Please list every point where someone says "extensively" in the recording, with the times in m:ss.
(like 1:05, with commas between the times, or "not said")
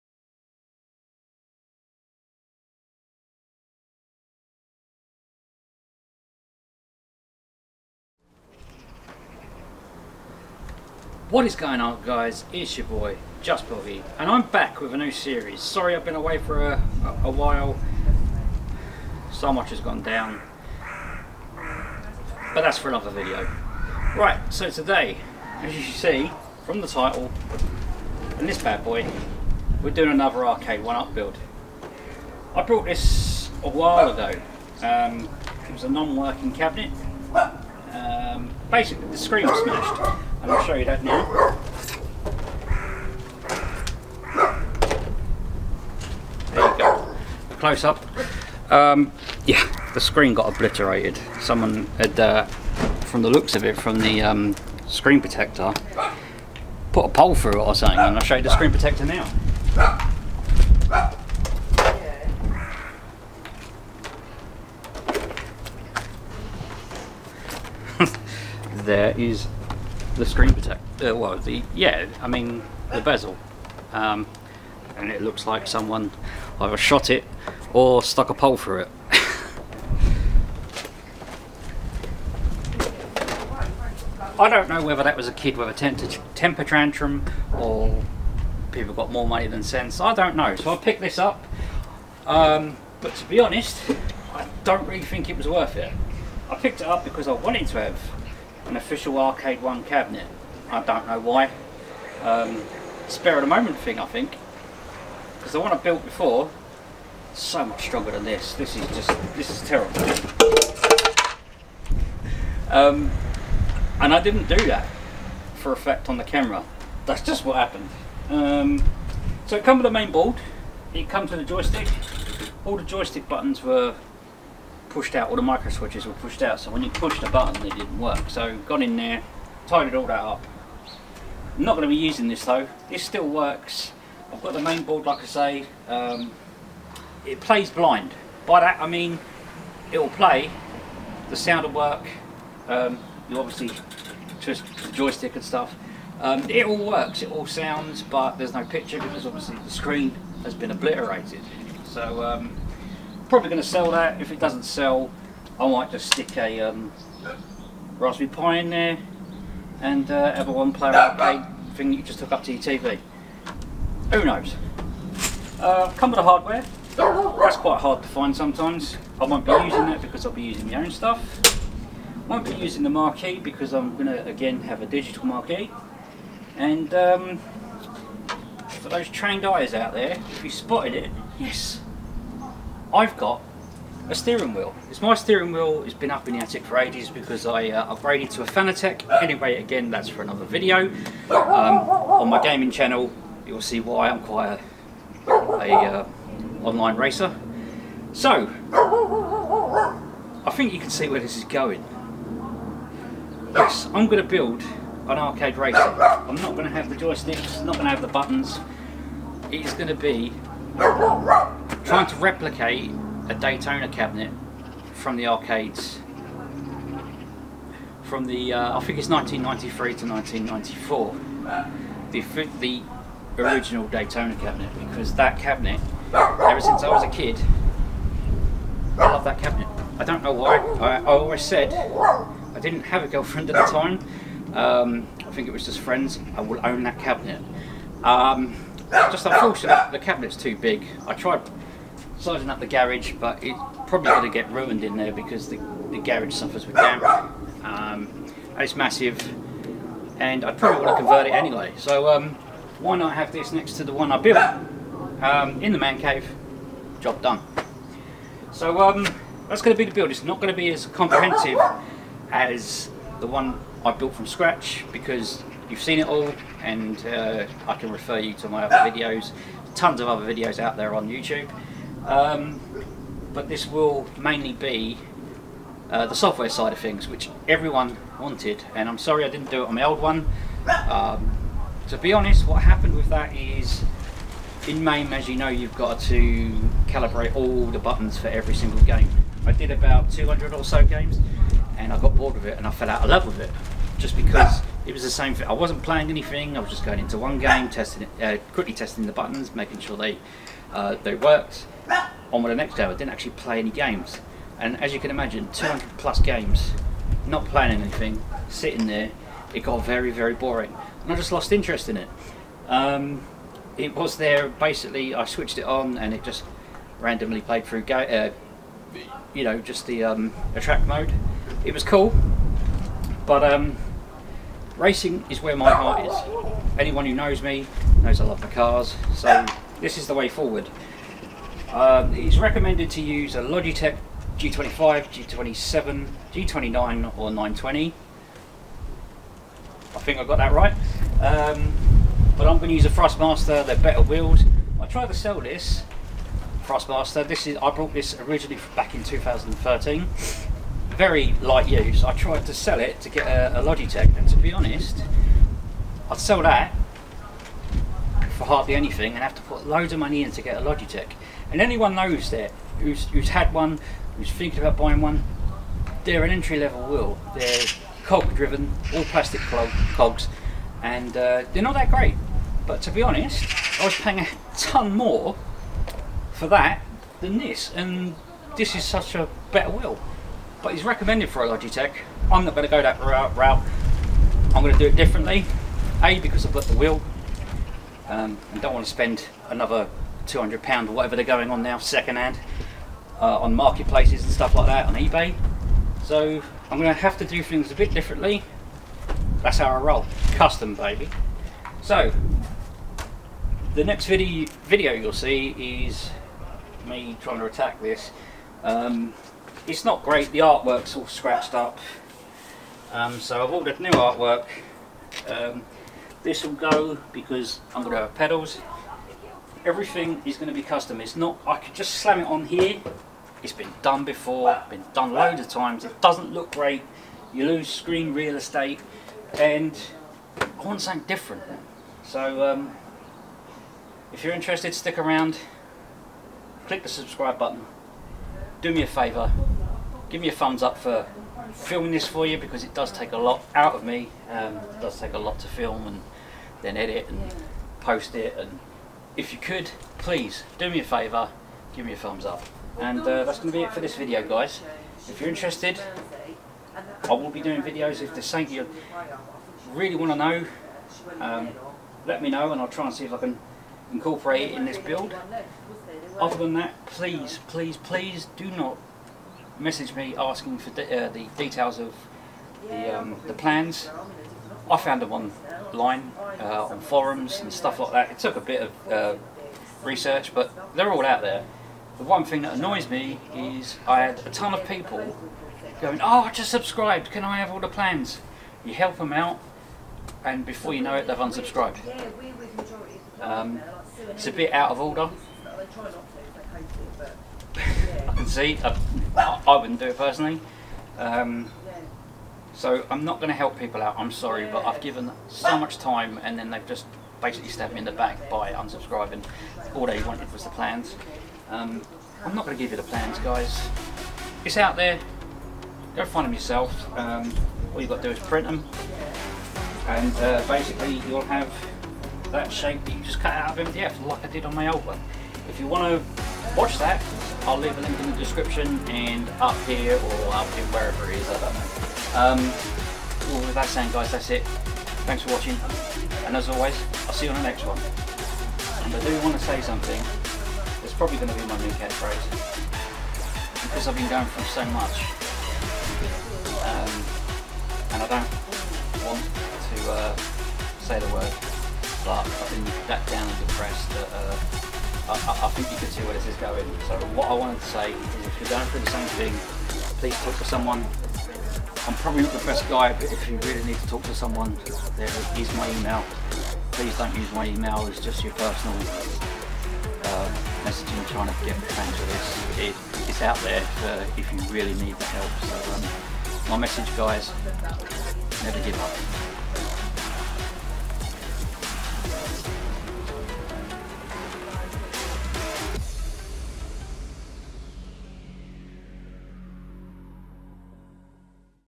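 not said.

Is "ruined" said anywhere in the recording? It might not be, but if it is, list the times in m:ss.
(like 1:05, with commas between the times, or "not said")
4:04.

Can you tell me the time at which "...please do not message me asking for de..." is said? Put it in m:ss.
7:47.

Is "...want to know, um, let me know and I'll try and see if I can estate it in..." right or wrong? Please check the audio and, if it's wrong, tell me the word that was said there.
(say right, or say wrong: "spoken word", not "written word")
wrong: "incorporate", not "estate".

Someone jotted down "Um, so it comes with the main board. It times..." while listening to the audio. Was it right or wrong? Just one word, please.
wrong.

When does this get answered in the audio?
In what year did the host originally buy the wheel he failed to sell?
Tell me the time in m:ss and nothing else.
5:49.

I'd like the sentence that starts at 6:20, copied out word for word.
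But it's recommended for a Logitech.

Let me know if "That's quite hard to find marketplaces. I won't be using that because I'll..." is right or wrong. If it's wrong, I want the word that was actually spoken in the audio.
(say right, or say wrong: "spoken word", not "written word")
wrong: "sometimes", not "marketplaces".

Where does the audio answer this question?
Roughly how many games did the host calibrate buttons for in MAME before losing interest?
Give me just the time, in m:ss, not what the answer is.
4:49.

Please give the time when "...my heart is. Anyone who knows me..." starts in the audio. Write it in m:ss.
5:25.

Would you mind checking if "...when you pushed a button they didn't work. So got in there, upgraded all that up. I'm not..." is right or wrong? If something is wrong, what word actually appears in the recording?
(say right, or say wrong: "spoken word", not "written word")
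wrong: "tidied", not "upgraded".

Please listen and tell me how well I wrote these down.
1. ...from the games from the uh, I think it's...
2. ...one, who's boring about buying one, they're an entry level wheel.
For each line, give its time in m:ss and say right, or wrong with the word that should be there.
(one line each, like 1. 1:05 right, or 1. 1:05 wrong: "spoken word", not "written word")
1. 3:34 wrong: "arcades", not "games"
2. 6:03 wrong: "thinking", not "boring".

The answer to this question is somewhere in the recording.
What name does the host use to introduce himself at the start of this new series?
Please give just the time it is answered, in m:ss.
0:13.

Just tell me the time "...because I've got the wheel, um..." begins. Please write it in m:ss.
6:26.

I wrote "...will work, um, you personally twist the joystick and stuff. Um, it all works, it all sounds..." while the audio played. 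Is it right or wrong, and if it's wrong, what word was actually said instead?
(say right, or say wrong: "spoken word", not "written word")
wrong: "obviously", not "personally".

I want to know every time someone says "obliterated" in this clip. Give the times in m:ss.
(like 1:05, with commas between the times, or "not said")
0:50, 2:30.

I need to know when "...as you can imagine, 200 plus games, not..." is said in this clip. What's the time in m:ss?
5:04.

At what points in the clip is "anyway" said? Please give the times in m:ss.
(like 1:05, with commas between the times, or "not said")
3:09, 4:11.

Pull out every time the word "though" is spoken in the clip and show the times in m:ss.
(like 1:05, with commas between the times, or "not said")
2:12.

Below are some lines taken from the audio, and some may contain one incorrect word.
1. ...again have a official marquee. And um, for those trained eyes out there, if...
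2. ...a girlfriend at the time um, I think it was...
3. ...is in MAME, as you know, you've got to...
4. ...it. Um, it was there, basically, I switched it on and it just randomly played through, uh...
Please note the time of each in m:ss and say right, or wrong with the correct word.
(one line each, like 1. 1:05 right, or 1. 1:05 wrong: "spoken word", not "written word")
1. 2:54 wrong: "digital", not "official"
2. 3:53 right
3. 4:43 right
4. 5:11 right.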